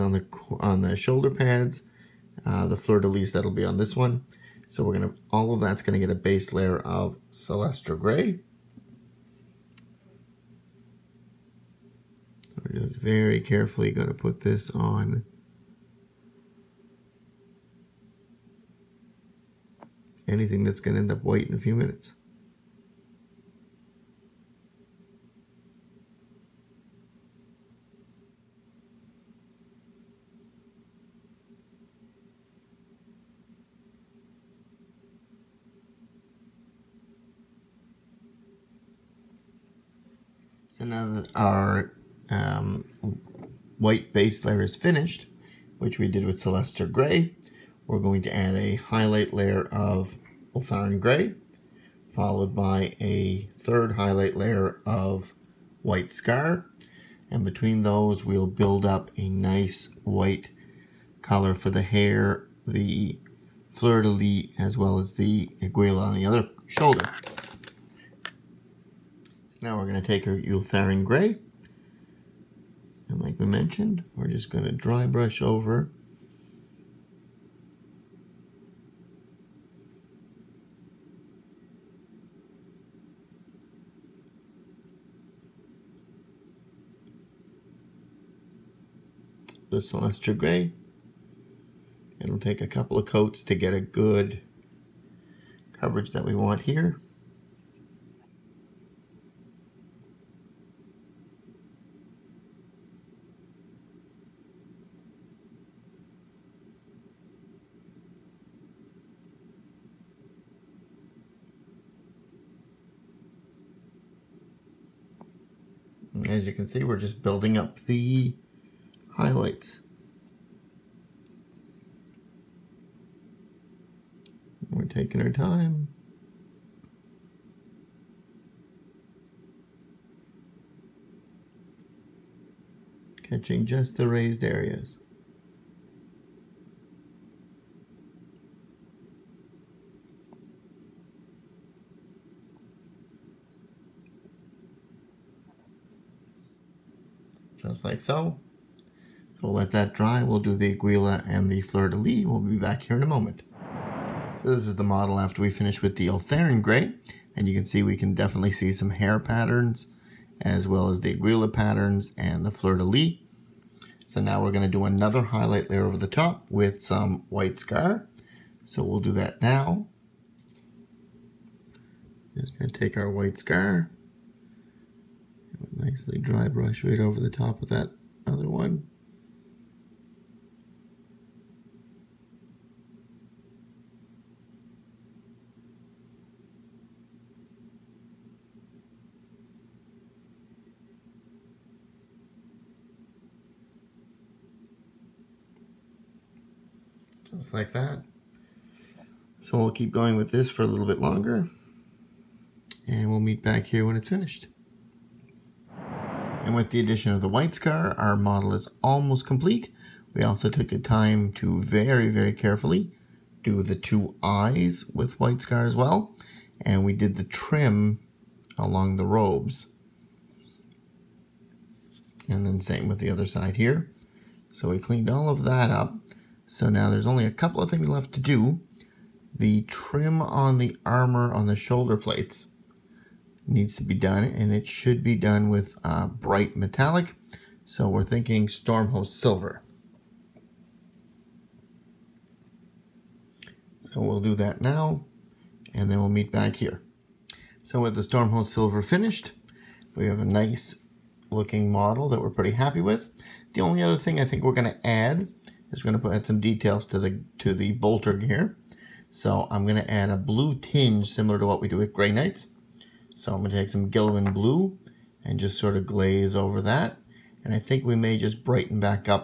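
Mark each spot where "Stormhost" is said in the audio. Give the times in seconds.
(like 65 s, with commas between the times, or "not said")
238 s, 248 s.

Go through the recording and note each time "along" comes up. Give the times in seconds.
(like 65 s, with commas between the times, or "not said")
218 s.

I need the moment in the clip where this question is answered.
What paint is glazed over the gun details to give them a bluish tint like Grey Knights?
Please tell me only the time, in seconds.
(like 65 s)
263 s.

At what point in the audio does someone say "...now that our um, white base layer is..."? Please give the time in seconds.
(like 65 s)
40 s.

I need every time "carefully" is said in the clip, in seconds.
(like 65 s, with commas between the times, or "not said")
13 s, 212 s.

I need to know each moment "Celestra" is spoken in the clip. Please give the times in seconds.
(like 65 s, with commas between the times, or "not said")
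7 s, 46 s, 89 s.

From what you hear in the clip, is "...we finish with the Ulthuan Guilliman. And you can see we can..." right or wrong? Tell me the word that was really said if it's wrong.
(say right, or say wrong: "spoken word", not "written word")
wrong: "Grey", not "Guilliman".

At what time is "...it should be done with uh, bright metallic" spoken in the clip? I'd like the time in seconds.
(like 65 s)
234 s.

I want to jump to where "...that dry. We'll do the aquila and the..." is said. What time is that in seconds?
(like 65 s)
149 s.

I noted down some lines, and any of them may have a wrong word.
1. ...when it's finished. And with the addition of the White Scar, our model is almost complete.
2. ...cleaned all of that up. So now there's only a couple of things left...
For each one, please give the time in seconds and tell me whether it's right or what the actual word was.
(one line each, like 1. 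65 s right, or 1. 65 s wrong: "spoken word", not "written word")
1. 203 s right
2. 224 s right.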